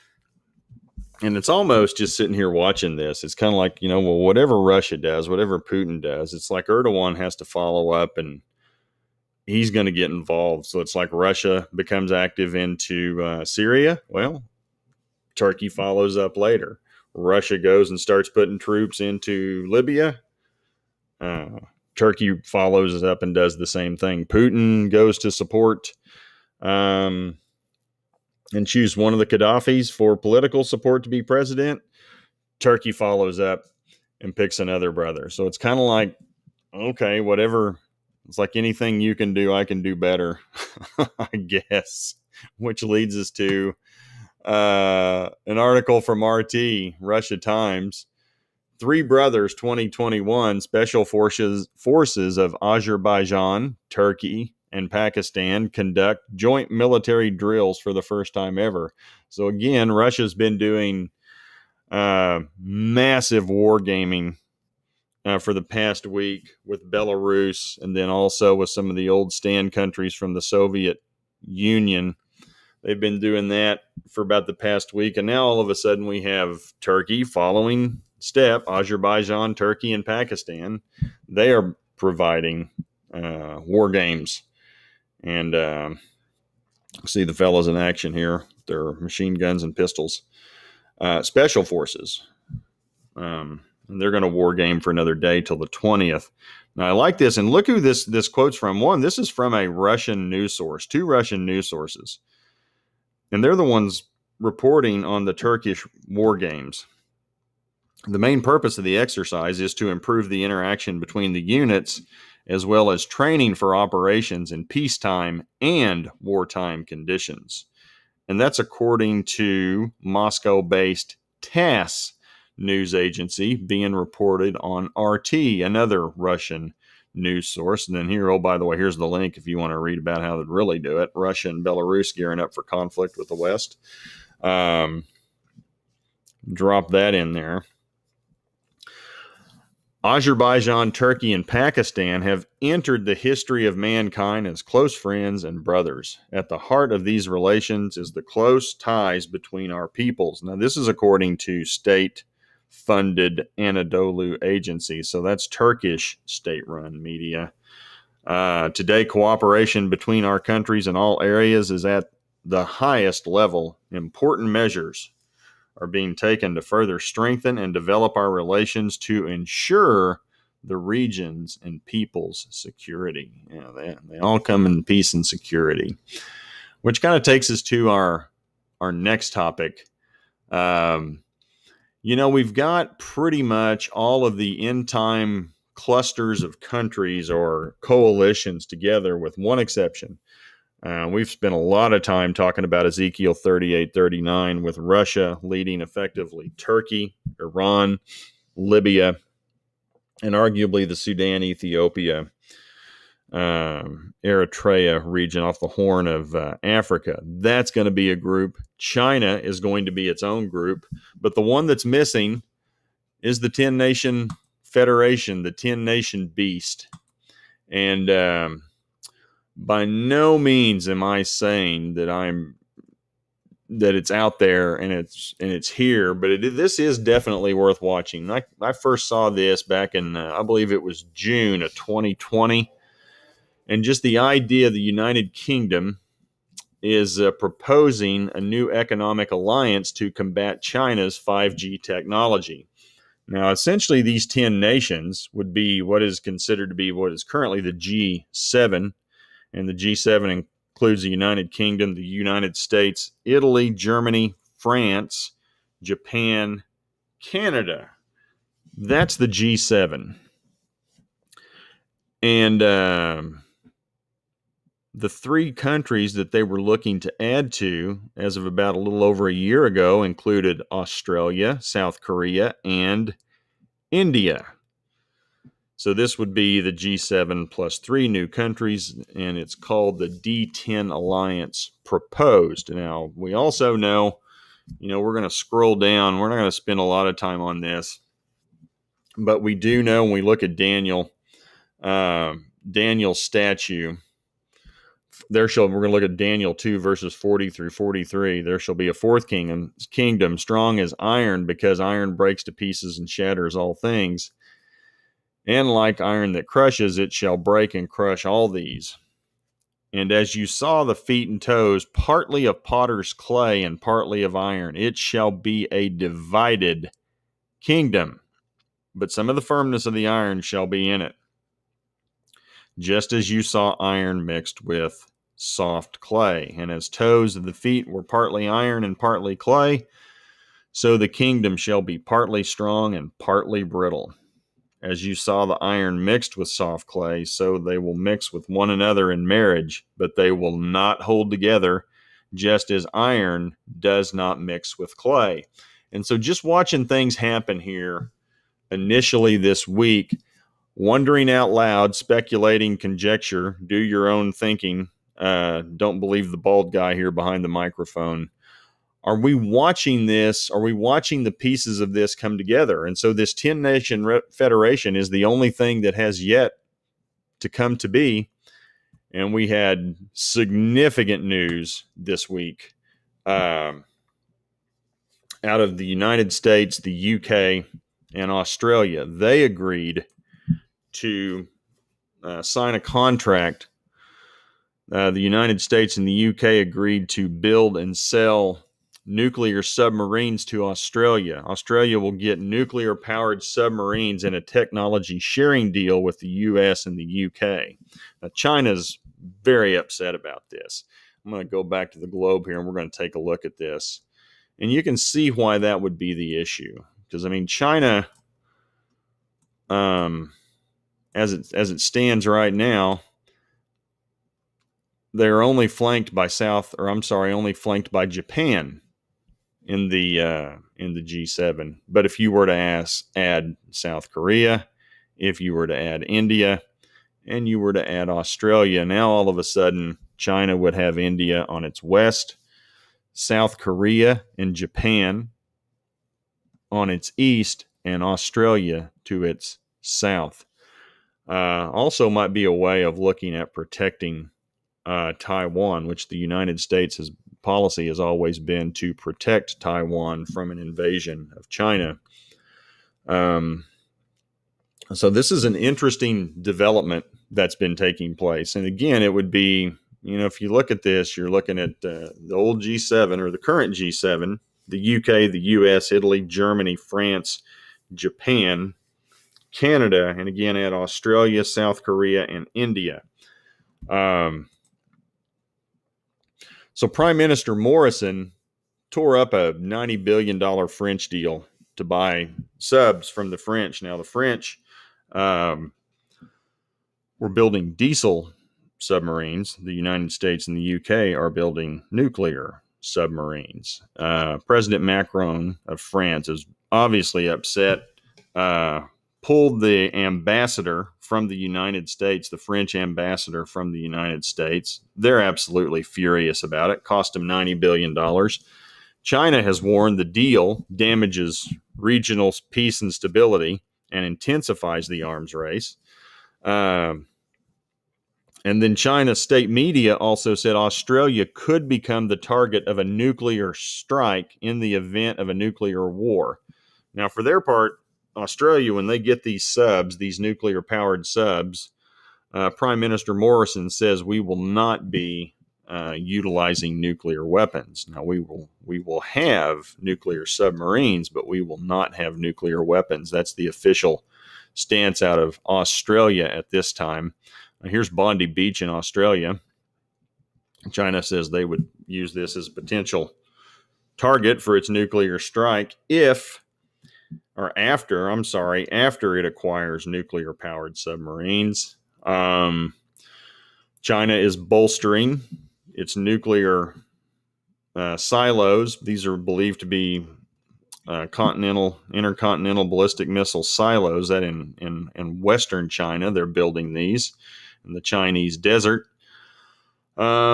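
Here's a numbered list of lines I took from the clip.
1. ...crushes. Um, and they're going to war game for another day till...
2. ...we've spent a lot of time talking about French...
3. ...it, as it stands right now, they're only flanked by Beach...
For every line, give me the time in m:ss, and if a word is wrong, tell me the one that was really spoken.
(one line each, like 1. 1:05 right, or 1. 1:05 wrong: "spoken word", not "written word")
1. 1:31 wrong: "forces", not "crushes"
2. 3:11 wrong: "Ezekiel", not "French"
3. 6:51 wrong: "South", not "Beach".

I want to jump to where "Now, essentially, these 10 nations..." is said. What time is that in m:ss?
4:03.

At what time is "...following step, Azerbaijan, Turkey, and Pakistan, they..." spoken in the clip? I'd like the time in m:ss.
1:17.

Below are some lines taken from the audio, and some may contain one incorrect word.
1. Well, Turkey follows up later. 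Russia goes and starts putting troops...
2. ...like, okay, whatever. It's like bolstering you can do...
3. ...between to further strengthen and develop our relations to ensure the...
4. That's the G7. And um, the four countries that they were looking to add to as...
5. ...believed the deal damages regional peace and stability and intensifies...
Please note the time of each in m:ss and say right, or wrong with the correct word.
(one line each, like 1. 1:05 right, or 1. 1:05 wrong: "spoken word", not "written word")
1. 0:14 right
2. 0:35 wrong: "anything", not "bolstering"
3. 2:46 wrong: "taken", not "between"
4. 4:18 wrong: "three", not "four"
5. 8:29 wrong: "warned", not "believed".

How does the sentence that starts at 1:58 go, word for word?
And that's according to Moscow based TASS news agency being reported on RT, another Russian news source.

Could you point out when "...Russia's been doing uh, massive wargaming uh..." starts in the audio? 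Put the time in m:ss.
0:59.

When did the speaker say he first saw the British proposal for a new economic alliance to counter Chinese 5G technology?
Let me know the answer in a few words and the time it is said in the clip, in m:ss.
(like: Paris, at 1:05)
June of 2020, at 3:51.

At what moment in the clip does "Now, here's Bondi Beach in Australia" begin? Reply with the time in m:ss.
9:07.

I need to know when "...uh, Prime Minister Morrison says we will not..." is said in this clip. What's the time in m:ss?
8:52.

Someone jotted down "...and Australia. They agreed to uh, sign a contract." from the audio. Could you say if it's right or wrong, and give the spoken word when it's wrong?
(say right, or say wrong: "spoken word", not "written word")
right.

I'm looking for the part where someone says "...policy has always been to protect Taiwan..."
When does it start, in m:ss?
7:27.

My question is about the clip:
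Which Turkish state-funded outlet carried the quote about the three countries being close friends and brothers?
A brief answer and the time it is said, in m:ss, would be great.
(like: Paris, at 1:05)
Anadolu Agency, at 2:33.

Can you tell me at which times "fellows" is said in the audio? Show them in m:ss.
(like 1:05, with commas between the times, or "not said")
1:27.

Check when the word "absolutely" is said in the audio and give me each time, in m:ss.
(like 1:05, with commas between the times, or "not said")
8:25.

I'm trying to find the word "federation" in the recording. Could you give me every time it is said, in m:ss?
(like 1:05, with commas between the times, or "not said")
3:34, 6:04.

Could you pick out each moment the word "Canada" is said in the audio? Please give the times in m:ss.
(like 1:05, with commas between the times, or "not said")
4:17, 7:49.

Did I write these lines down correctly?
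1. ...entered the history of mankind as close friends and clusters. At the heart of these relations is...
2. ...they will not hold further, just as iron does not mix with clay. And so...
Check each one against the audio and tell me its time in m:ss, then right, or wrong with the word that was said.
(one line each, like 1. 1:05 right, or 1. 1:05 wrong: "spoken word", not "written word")
1. 2:22 wrong: "brothers", not "clusters"
2. 5:40 wrong: "together", not "further".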